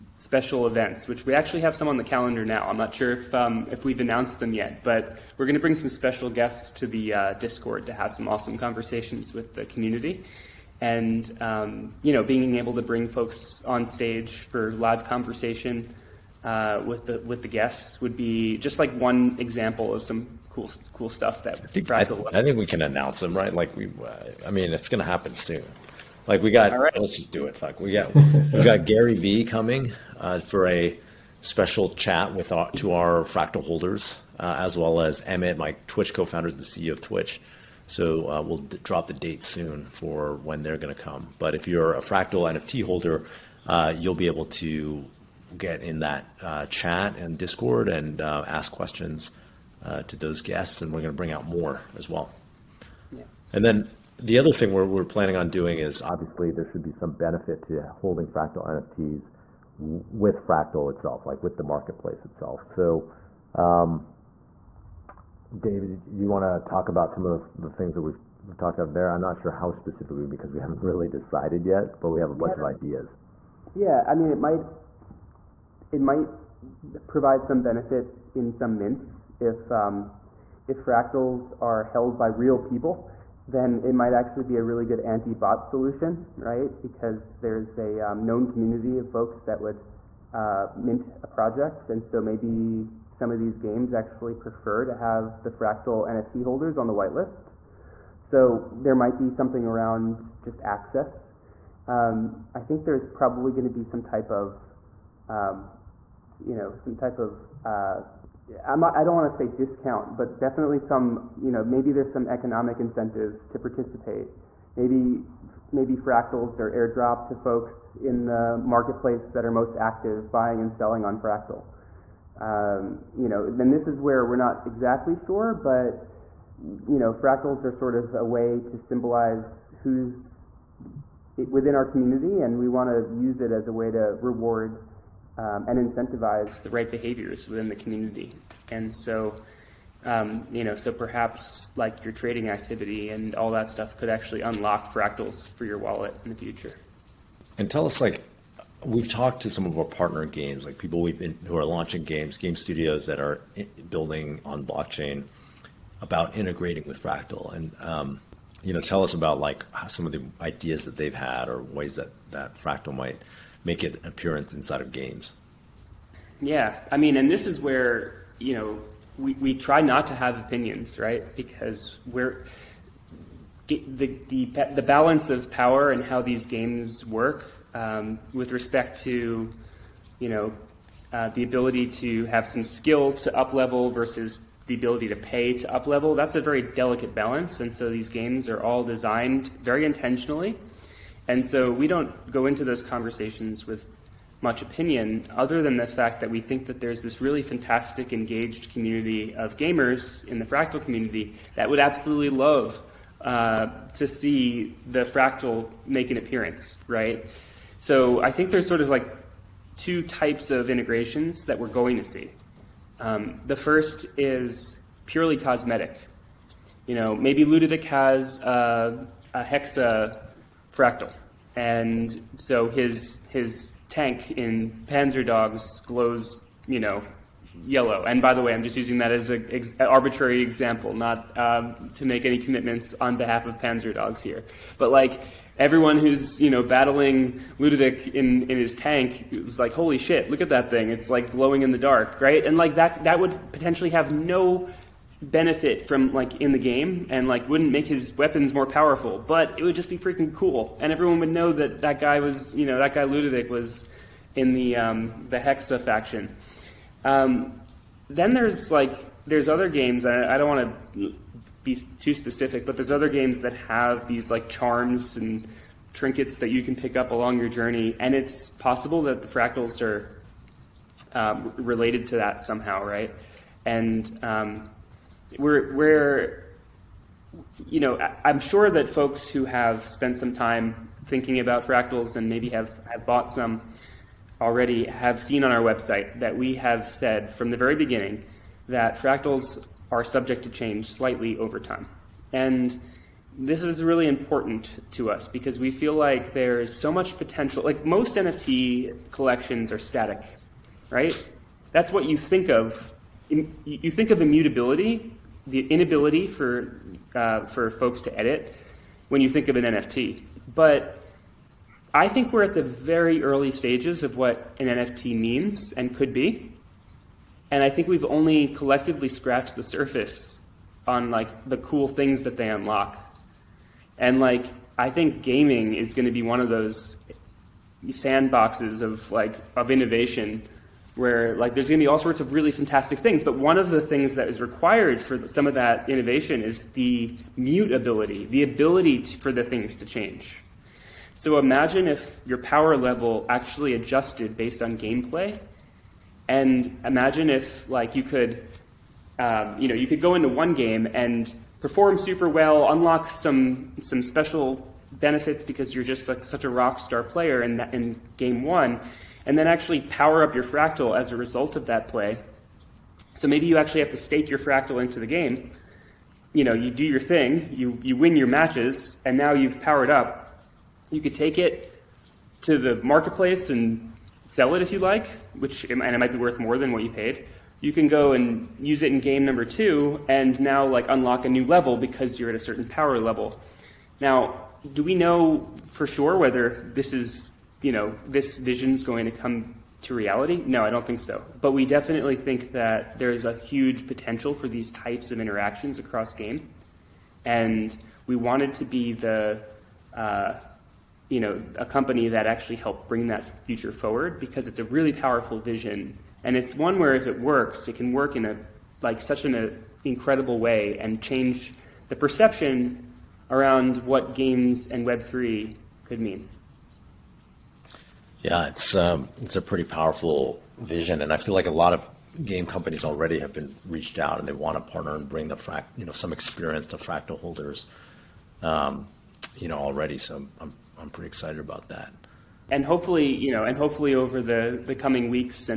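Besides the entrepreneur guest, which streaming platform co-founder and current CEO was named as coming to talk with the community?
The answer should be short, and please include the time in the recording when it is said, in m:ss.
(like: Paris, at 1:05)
Emmett, at 0:35.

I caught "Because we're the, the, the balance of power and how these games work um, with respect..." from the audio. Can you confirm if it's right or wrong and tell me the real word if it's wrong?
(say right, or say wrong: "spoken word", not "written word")
right.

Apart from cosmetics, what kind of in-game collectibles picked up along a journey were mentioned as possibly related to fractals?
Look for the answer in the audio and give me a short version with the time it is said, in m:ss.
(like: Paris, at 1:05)
charms and trinkets, at 4:24.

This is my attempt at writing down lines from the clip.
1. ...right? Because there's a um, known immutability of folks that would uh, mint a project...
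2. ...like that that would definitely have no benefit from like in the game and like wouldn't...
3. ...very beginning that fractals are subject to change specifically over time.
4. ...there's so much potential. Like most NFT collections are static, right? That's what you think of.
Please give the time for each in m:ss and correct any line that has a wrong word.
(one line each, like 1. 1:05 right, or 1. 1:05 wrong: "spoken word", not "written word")
1. 1:26 wrong: "community", not "immutability"
2. 4:02 wrong: "potentially", not "definitely"
3. 4:47 wrong: "slightly", not "specifically"
4. 4:56 right.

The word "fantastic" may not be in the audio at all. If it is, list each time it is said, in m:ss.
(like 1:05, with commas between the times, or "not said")
3:17, 5:32.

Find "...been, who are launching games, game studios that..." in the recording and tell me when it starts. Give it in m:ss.
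2:31.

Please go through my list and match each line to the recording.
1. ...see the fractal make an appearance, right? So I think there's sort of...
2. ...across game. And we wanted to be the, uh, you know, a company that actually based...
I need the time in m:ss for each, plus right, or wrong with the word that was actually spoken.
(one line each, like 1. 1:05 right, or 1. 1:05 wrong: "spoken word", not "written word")
1. 3:24 right
2. 6:35 wrong: "helped", not "based".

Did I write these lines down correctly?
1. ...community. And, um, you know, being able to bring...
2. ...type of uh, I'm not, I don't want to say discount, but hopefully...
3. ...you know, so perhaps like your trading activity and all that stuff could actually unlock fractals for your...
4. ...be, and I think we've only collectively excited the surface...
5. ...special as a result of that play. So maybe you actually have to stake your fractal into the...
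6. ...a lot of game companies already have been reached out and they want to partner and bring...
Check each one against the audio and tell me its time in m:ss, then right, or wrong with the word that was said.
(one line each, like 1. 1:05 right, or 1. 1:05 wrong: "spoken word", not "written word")
1. 0:09 right
2. 1:46 wrong: "definitely", not "hopefully"
3. 2:20 right
4. 5:16 wrong: "scratched", not "excited"
5. 6:00 wrong: "fractal", not "special"
6. 7:01 right.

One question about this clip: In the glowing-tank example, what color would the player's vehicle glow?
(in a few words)
yellow.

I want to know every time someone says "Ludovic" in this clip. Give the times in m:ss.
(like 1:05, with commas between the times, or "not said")
3:37, 3:57, 4:13.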